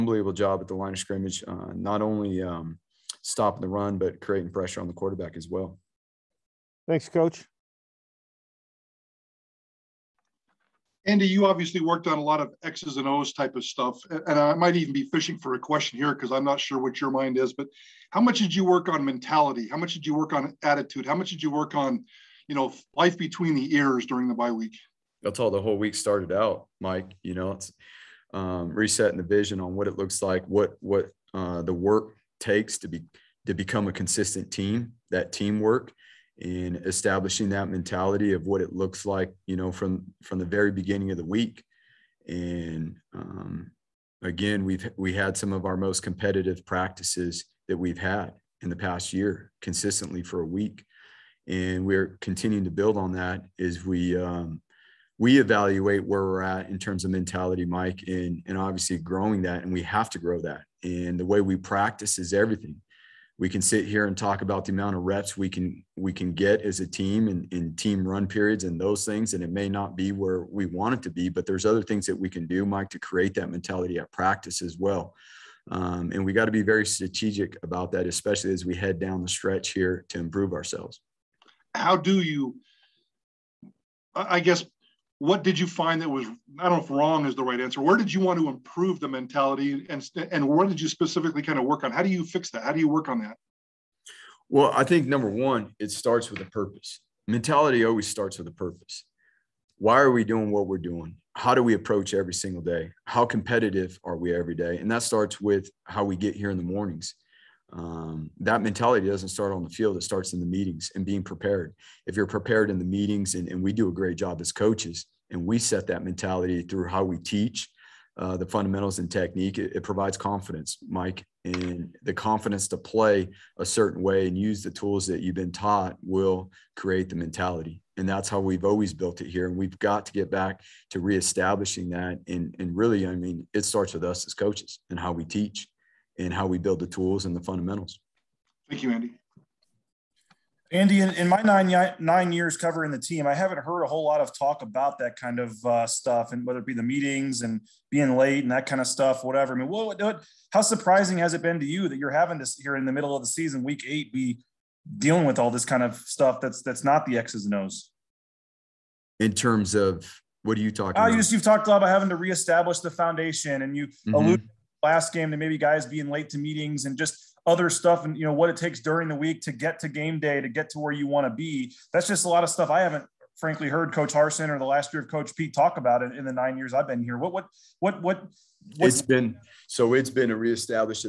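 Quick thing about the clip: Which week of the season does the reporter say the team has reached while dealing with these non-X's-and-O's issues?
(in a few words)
Week 8.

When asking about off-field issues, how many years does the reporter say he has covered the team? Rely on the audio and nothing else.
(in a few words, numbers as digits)
9.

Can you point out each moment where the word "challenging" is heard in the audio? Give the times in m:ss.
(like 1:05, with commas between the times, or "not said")
not said.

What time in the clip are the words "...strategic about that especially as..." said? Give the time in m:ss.
1:16.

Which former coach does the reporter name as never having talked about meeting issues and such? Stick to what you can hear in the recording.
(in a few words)
Coach Harsin.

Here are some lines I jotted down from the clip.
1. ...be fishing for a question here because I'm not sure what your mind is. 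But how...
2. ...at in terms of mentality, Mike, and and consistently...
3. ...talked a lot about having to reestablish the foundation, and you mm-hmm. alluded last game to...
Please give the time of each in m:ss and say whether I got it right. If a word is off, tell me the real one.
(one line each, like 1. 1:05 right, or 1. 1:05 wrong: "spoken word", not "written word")
1. 0:14 right
2. 0:56 wrong: "obviously", not "consistently"
3. 2:41 right.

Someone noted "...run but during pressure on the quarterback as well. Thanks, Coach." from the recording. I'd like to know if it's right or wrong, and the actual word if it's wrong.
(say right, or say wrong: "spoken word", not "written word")
wrong: "creating", not "during".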